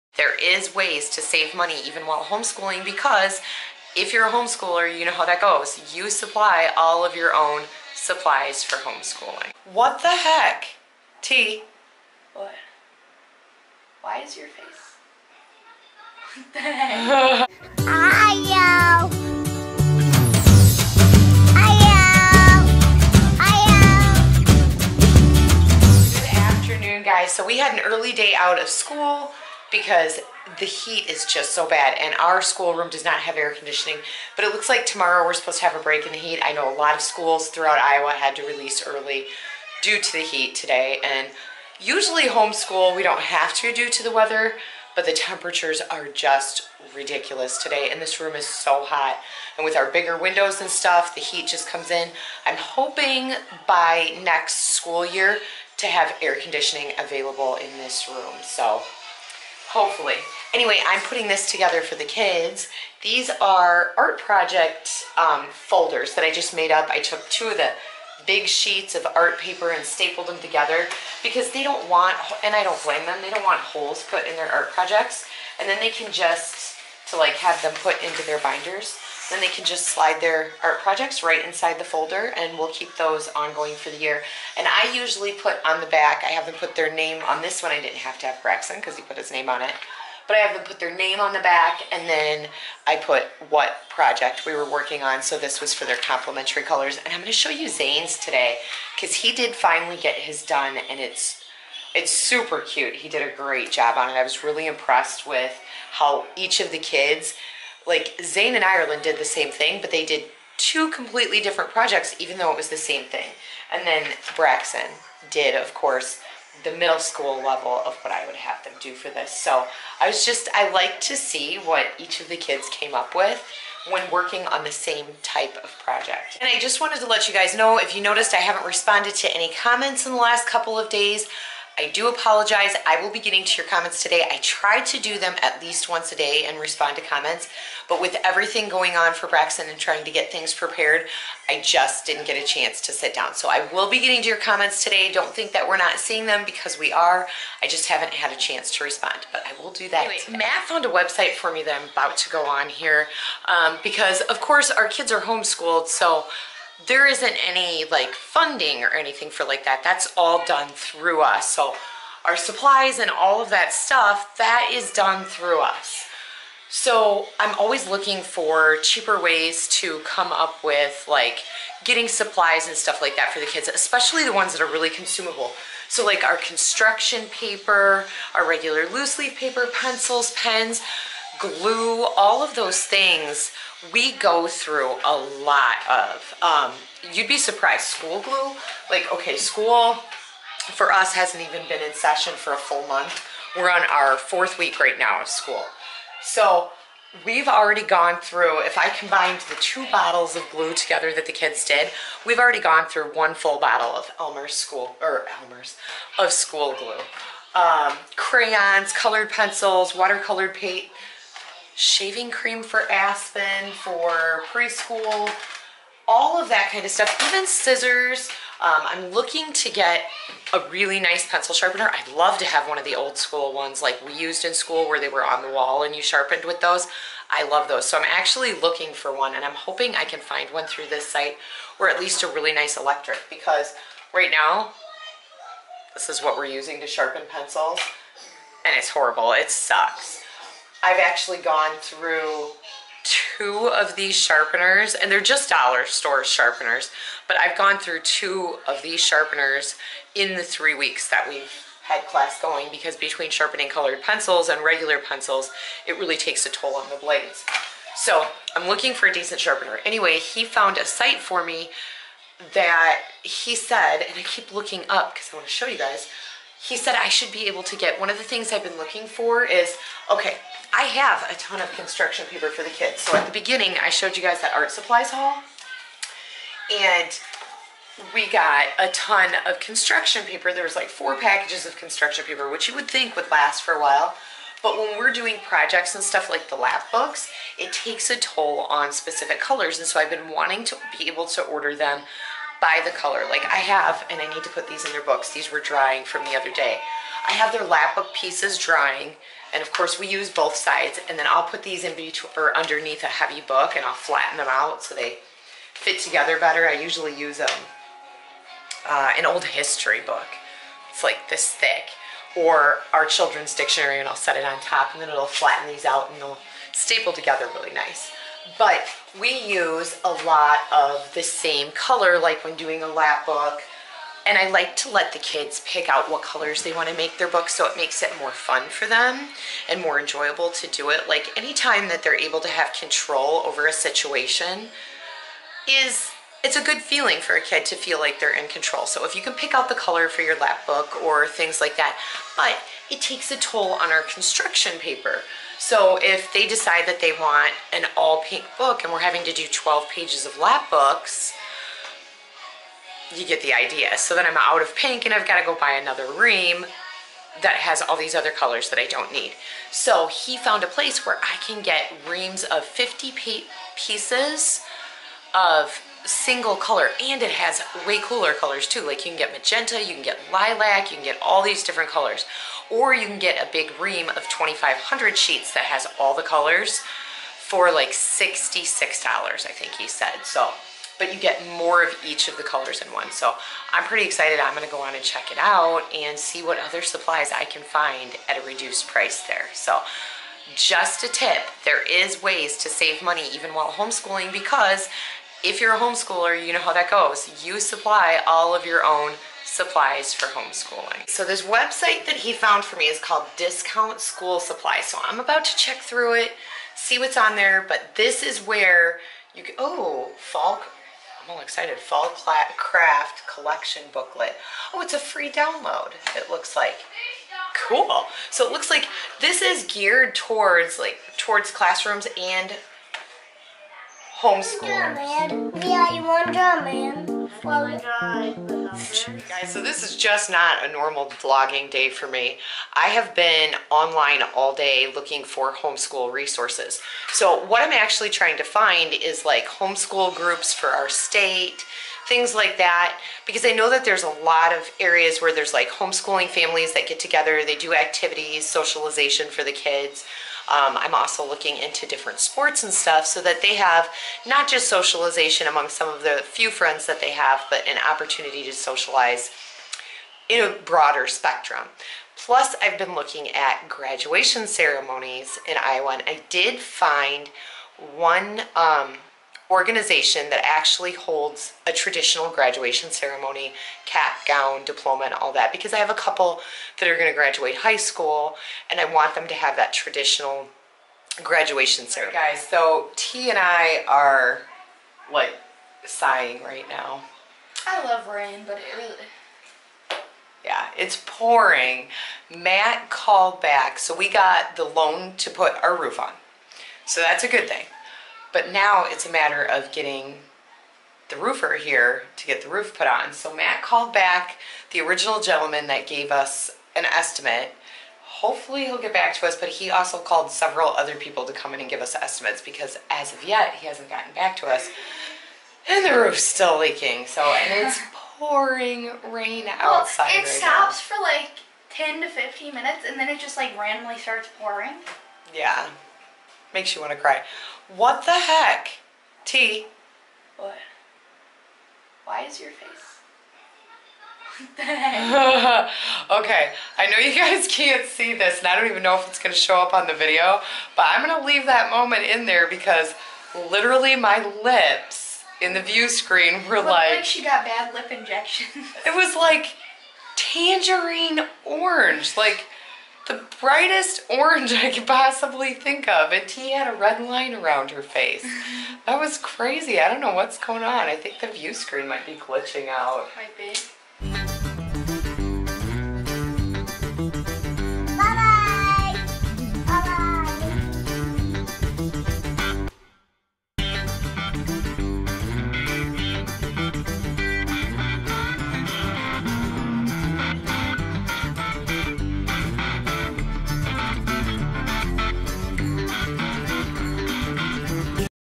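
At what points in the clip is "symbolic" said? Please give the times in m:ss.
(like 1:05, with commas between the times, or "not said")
not said.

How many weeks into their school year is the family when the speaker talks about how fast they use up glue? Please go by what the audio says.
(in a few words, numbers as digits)
4.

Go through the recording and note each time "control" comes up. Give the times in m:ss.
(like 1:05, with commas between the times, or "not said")
5:32, 5:38.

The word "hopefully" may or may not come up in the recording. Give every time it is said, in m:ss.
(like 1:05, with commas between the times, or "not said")
0:59, 8:28.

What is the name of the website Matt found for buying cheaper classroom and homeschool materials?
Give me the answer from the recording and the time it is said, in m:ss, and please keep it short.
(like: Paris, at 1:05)
Discount School Supply, at 6:43.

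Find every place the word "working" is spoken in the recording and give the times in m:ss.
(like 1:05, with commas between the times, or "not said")
1:34, 2:04.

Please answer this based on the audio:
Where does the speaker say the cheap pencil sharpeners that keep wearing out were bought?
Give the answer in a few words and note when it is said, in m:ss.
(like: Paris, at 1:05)
dollar store, at 4:05.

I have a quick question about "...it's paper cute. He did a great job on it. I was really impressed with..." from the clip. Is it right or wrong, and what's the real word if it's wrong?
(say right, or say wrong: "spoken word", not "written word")
wrong: "super", not "paper".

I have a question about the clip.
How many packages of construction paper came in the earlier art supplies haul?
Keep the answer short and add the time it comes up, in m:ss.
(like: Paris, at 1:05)
4, at 4:40.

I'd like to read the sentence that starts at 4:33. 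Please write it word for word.
So at the beginning, I showed you guys that art supplies haul.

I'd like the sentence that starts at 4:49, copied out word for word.
And so I've been wanting to be able to order them by the color.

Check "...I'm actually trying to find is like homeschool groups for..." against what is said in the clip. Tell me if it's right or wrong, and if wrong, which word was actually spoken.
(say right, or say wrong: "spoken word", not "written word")
right.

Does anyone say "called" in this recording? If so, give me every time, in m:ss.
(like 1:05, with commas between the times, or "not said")
6:42, 8:12, 8:23, 8:29.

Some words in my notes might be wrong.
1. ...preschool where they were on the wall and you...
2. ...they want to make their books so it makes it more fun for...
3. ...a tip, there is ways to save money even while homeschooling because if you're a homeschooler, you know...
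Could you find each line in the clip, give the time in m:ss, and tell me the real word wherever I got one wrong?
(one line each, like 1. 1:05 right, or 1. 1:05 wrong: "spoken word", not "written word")
1. 3:44 wrong: "school", not "preschool"
2. 5:26 right
3. 6:31 right.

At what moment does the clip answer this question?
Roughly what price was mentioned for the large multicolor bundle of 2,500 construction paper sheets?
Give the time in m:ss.
6:17.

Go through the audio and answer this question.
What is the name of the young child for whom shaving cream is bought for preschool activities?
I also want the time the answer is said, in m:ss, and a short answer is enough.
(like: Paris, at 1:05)
Aspen, at 3:32.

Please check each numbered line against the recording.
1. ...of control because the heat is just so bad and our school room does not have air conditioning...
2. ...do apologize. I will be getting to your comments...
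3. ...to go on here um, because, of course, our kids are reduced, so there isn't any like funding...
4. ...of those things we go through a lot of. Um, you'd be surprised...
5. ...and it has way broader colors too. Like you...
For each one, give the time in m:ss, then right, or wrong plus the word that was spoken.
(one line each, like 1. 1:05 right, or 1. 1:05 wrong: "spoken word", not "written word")
1. 0:28 wrong: "school", not "control"
2. 2:11 right
3. 2:32 wrong: "homeschooled", not "reduced"
4. 3:02 right
5. 6:07 wrong: "cooler", not "broader".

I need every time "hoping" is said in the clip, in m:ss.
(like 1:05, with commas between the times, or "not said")
0:52, 3:49.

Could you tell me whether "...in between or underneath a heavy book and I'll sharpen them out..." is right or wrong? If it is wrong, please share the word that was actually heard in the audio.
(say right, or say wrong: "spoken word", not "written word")
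wrong: "flatten", not "sharpen".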